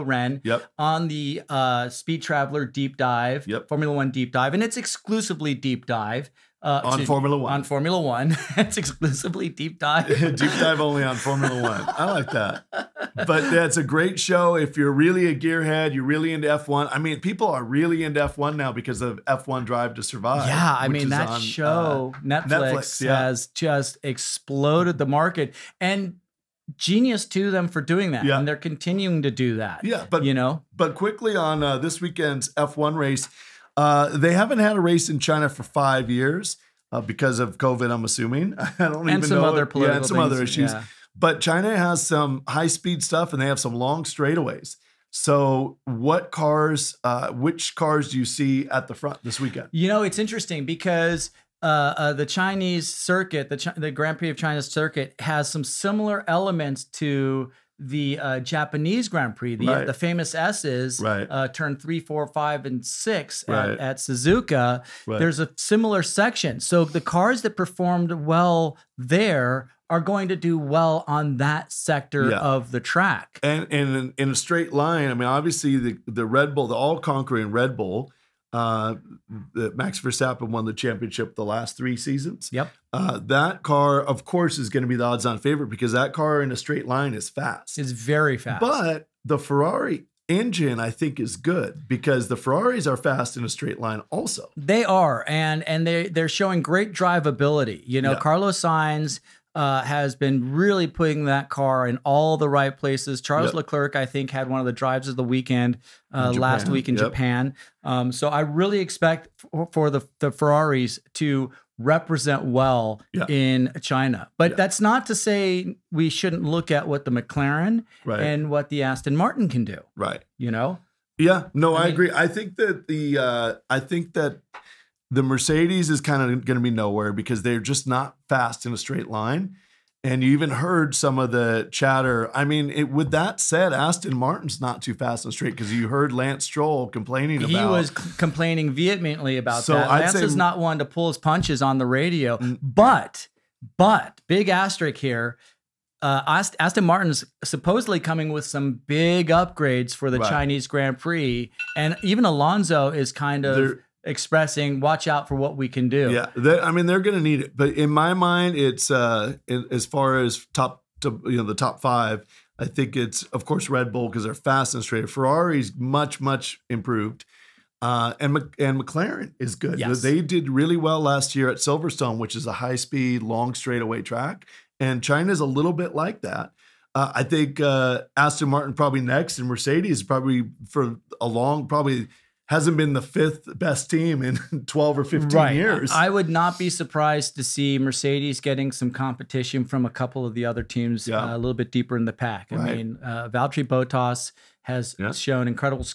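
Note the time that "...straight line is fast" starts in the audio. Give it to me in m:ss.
1:26.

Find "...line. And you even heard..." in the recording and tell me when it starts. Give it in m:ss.
2:09.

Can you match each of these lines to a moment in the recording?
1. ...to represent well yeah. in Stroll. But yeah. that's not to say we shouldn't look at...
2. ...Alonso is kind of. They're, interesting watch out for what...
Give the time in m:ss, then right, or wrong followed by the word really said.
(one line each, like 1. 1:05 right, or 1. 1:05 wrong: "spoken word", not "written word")
1. 1:51 wrong: "China", not "Stroll"
2. 2:32 wrong: "expressing", not "interesting".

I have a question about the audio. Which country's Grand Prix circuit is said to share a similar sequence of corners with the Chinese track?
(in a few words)
Japan.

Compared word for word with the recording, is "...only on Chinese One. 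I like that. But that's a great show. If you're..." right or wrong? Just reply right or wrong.
wrong.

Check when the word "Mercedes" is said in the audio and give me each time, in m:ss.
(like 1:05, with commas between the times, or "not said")
2:05, 2:59, 3:07.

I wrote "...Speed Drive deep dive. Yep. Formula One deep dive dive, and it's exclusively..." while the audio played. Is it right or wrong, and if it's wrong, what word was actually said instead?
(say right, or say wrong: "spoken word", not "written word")
wrong: "Traveler", not "Drive".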